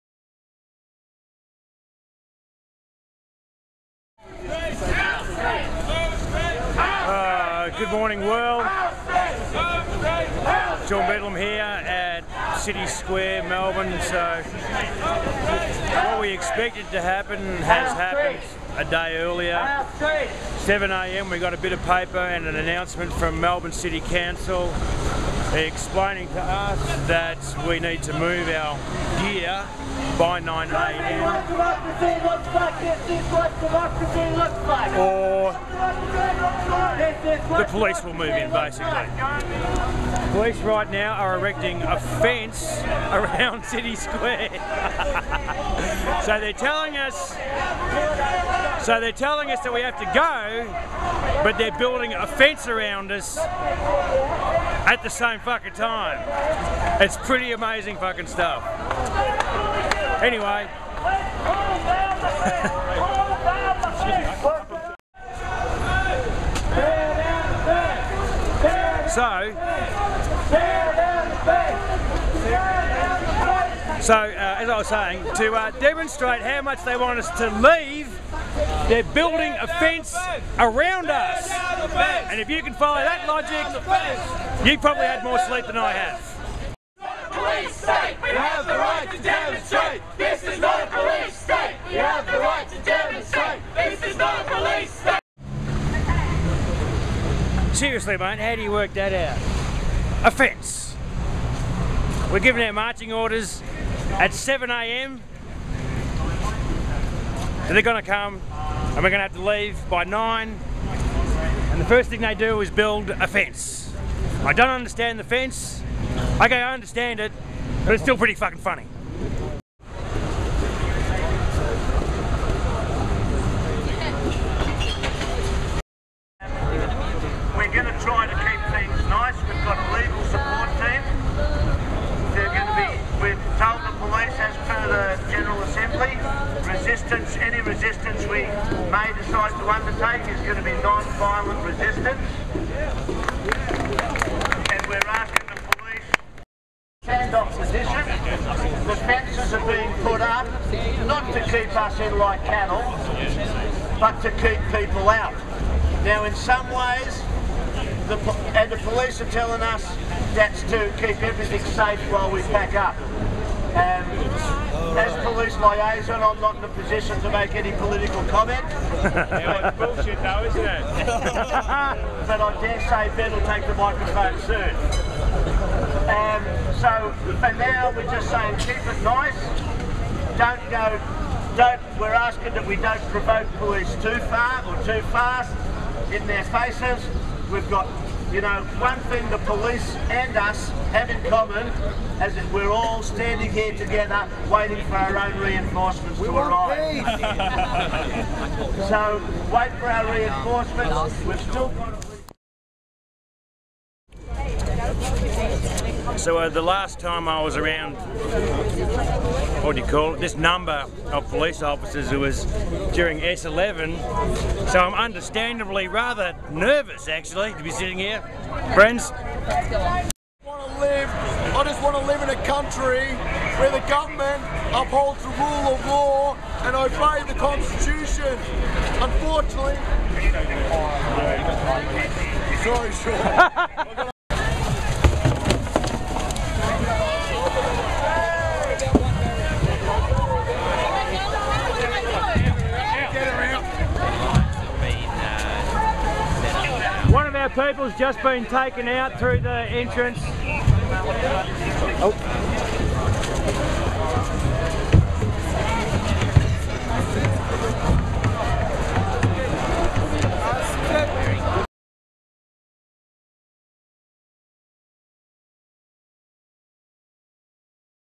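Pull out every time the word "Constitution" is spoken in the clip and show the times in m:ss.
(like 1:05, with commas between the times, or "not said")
3:47.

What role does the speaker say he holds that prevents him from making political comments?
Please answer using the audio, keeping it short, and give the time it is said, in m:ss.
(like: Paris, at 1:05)
Police liaison, at 2:45.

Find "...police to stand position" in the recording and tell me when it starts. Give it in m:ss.
2:25.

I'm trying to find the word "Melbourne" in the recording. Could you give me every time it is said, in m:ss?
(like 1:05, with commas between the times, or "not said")
0:13, 0:23.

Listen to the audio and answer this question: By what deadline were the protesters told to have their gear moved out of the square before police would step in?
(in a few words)
9 a.m.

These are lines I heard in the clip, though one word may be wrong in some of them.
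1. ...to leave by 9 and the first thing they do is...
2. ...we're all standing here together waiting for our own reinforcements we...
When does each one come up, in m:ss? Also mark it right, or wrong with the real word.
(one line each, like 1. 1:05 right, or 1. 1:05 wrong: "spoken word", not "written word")
1. 1:49 right
2. 3:12 right.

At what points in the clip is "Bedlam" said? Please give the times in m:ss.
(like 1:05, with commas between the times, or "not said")
0:11.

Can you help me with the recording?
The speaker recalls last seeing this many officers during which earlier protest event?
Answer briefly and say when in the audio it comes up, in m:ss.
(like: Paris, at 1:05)
S11, at 3:33.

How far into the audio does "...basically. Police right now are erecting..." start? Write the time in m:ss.
0:38.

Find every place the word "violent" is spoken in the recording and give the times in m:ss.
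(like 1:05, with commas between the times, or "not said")
2:20.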